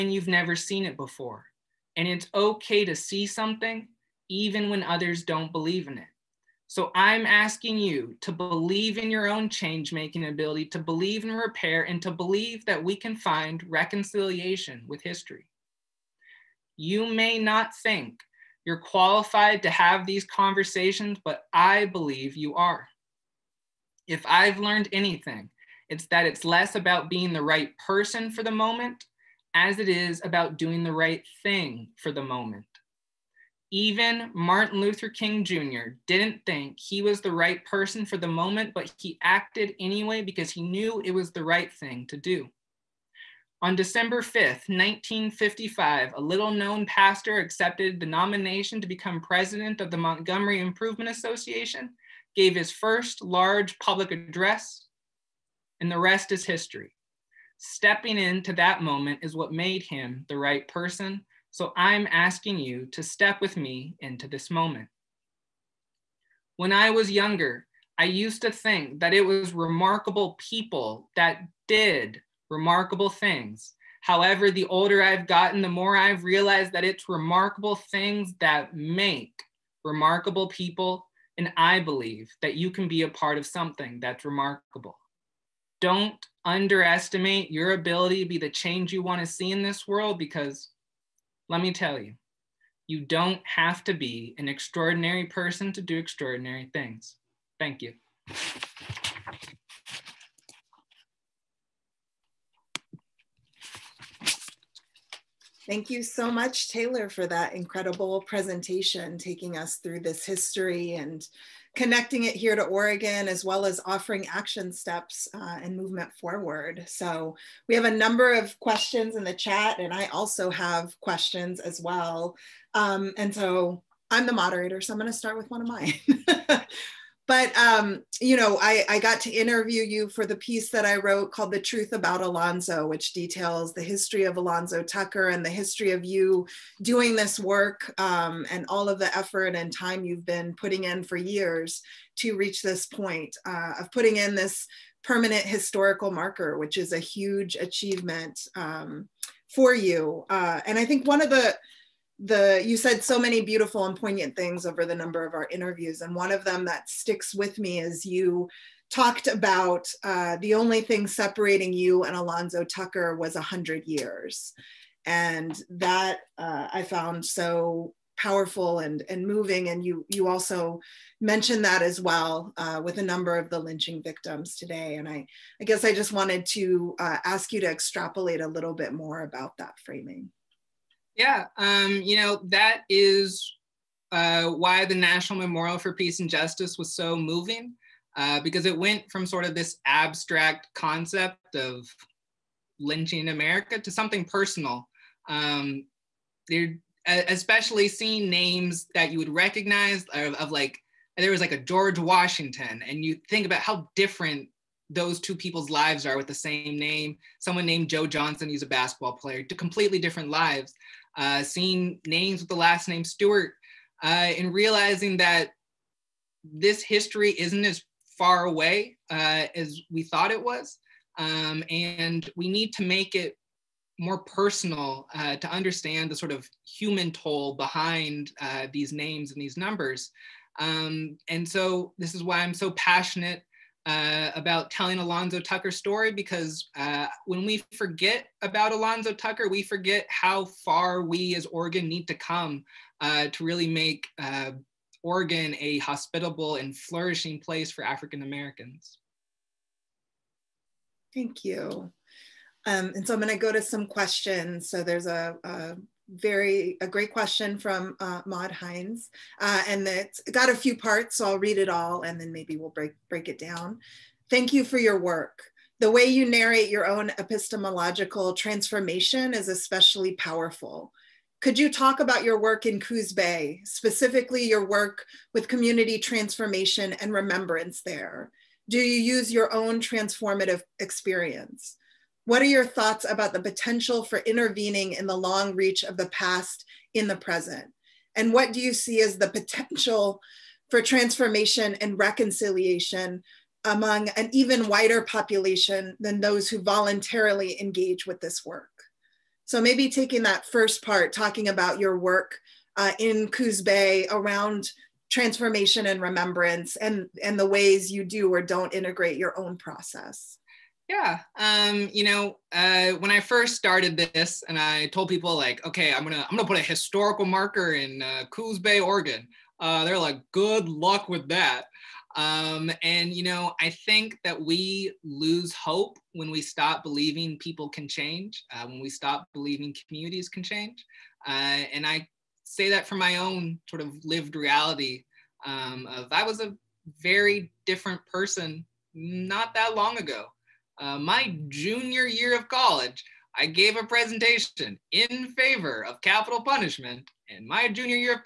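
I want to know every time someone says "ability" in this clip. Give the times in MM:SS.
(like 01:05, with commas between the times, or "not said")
00:10, 01:27.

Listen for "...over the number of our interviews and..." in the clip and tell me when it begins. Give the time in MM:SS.
02:34.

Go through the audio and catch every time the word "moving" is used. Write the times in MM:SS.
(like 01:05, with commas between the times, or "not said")
02:49, 03:07.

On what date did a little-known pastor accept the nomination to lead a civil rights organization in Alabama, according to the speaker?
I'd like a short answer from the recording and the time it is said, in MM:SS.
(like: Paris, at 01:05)
December 5th, 1955, at 00:43.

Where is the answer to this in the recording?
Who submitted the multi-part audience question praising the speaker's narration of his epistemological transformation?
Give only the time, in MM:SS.
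04:18.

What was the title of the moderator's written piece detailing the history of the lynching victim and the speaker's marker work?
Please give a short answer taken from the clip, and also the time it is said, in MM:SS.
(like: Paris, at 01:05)
The Truth About Alonzo, at 02:11.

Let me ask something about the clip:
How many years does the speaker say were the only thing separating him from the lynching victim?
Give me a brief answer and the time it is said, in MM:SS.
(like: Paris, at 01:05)
100, at 02:43.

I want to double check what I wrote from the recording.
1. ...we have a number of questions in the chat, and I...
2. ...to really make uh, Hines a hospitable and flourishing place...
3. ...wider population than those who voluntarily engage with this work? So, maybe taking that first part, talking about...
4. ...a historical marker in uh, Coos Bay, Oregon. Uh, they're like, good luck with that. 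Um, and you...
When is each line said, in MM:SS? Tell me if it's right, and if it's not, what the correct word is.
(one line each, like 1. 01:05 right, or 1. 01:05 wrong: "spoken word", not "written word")
1. 01:57 right
2. 04:03 wrong: "Oregon", not "Hines"
3. 04:54 right
4. 05:16 right.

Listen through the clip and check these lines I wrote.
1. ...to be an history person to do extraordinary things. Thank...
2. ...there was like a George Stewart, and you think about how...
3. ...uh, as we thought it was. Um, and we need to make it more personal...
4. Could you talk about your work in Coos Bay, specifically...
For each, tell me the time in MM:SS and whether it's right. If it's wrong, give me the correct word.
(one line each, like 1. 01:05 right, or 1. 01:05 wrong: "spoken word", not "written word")
1. 01:33 wrong: "extraordinary", not "history"
2. 03:21 wrong: "Washington", not "Stewart"
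3. 03:39 right
4. 04:31 right.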